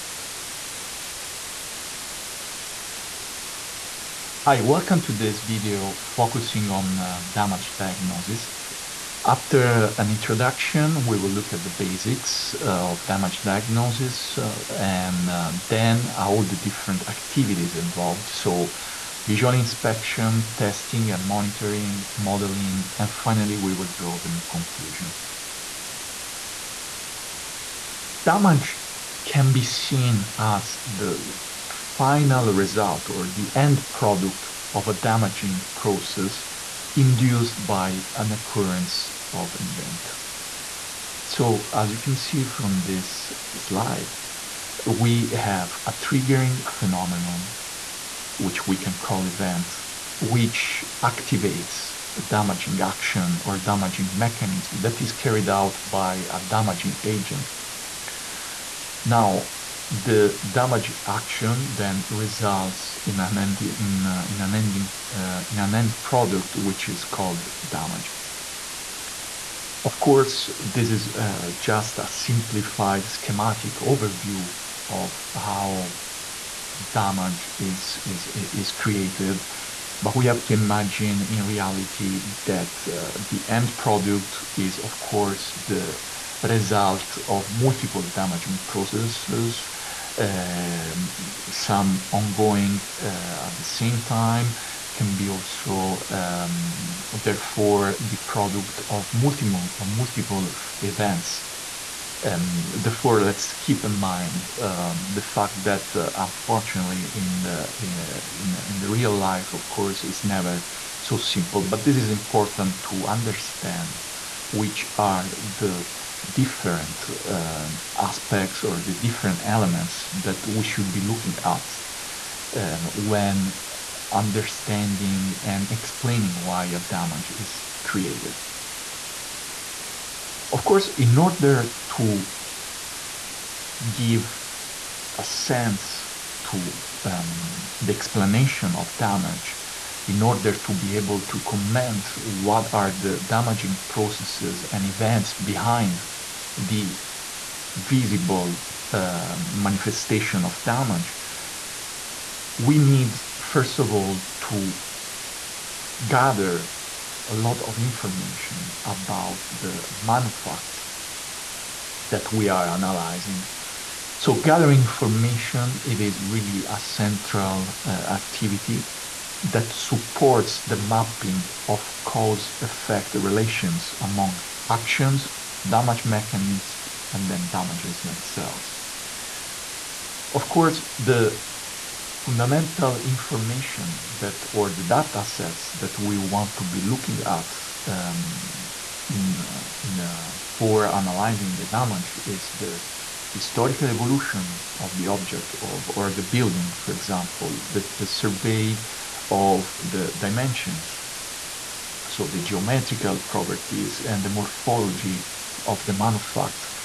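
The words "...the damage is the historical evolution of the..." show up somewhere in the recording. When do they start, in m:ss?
3:11.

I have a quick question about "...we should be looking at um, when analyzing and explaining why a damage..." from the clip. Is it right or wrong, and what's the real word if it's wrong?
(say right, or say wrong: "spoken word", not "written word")
wrong: "understanding", not "analyzing".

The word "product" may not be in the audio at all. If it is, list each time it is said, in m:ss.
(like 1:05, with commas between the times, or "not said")
0:33, 1:06, 1:23, 1:38.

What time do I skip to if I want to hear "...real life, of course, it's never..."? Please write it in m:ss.
1:48.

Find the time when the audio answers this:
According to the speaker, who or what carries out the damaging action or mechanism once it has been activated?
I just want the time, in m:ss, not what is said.
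0:56.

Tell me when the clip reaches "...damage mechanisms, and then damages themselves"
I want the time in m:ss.
2:55.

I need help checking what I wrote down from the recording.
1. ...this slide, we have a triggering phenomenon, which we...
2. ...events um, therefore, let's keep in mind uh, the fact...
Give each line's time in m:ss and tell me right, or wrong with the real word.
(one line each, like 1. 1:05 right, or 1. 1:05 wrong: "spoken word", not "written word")
1. 0:42 right
2. 1:40 right.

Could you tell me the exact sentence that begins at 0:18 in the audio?
So visual inspection, testing and monitoring, modeling, and finally, we will draw the main conclusions.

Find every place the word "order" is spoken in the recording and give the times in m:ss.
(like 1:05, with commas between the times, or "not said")
2:11, 2:20.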